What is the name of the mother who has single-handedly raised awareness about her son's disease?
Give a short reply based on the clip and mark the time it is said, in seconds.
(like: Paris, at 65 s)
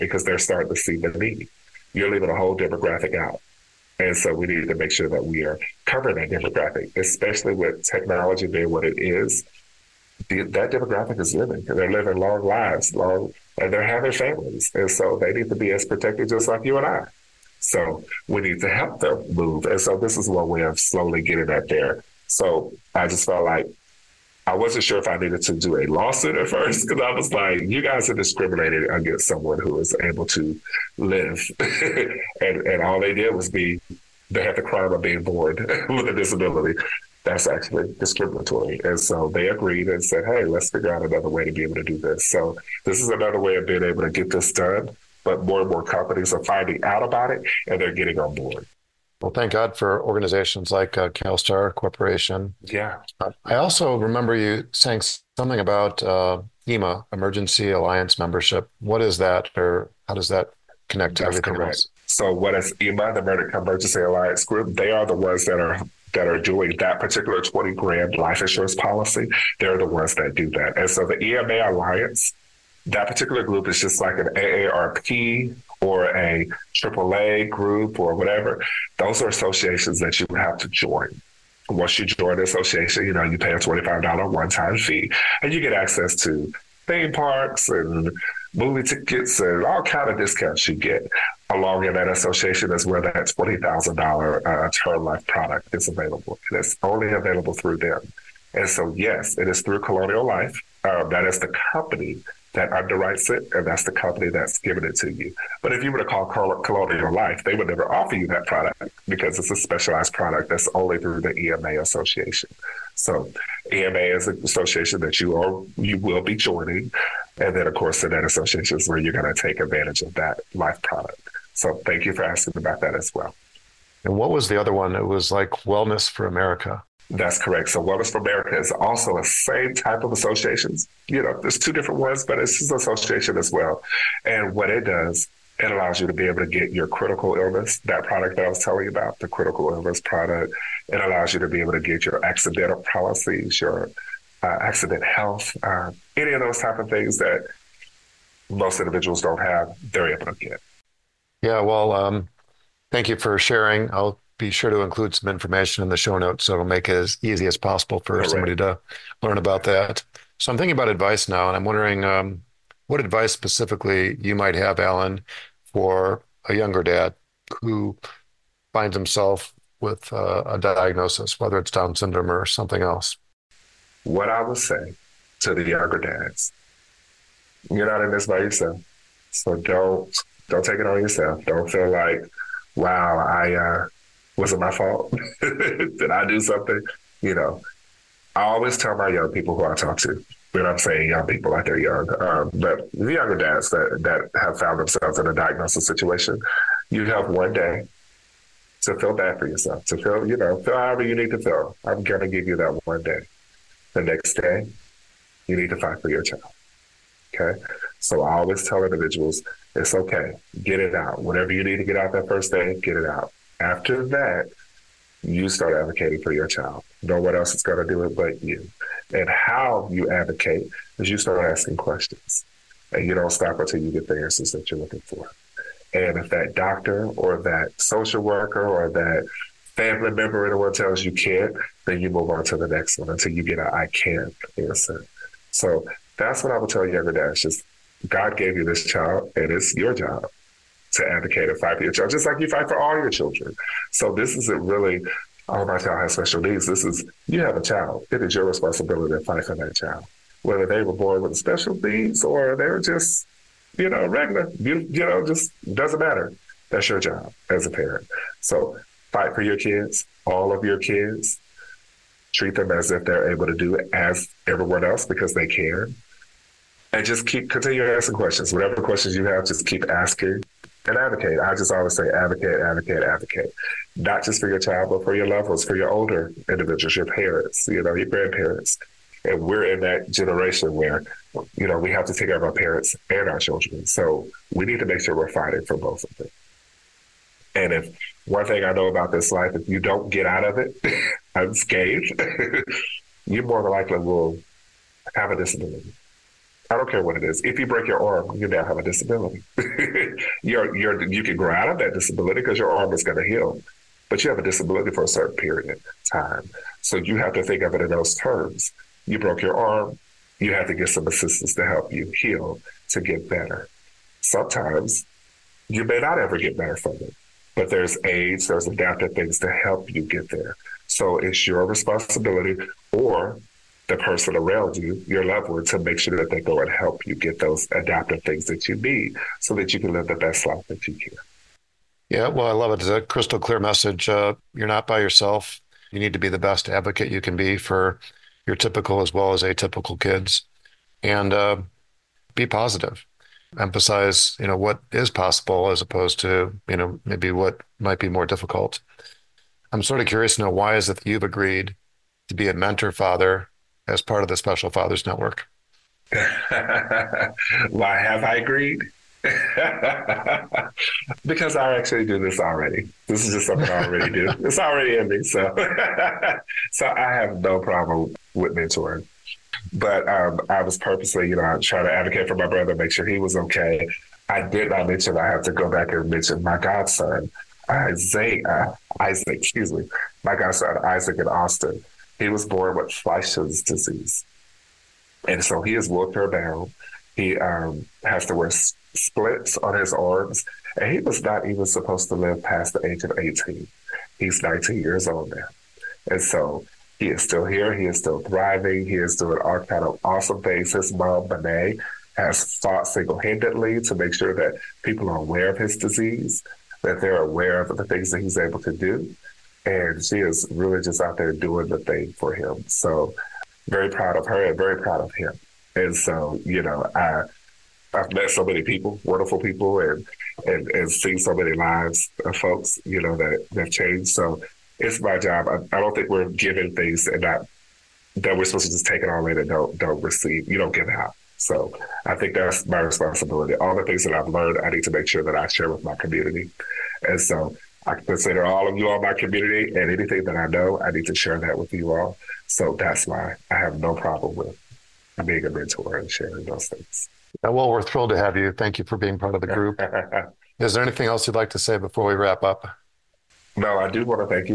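Benet, at 401 s.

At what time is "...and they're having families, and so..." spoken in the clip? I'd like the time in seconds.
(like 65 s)
13 s.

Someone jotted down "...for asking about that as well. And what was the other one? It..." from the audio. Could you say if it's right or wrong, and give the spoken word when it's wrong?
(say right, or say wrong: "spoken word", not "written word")
right.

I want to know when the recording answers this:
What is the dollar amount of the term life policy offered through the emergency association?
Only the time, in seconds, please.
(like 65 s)
93 s.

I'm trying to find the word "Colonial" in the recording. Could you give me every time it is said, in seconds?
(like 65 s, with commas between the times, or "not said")
99 s, 106 s.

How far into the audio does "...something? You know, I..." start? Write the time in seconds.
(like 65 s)
186 s.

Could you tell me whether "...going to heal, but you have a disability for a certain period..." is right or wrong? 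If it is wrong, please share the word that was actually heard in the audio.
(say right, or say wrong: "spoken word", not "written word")
right.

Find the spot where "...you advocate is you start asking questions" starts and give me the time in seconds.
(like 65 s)
219 s.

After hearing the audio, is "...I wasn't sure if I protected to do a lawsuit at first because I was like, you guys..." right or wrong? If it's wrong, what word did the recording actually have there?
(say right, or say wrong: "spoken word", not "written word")
wrong: "needed", not "protected".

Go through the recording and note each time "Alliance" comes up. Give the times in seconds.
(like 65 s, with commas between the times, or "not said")
57 s, 64 s, 71 s.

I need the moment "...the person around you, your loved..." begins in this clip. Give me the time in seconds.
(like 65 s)
323 s.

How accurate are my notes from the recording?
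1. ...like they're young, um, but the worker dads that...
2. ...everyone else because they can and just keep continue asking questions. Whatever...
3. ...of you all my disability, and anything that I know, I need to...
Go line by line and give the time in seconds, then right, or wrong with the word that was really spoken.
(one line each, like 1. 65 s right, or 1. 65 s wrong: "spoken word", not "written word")
1. 191 s wrong: "younger", not "worker"
2. 264 s right
3. 438 s wrong: "community", not "disability".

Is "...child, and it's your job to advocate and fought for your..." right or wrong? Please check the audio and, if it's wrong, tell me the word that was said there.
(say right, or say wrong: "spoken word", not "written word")
wrong: "fight", not "fought".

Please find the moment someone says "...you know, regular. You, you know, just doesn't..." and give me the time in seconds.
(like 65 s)
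253 s.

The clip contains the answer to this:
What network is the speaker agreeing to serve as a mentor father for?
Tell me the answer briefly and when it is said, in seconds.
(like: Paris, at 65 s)
Special Fathers Network, at 354 s.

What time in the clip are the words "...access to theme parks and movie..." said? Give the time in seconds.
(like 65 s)
85 s.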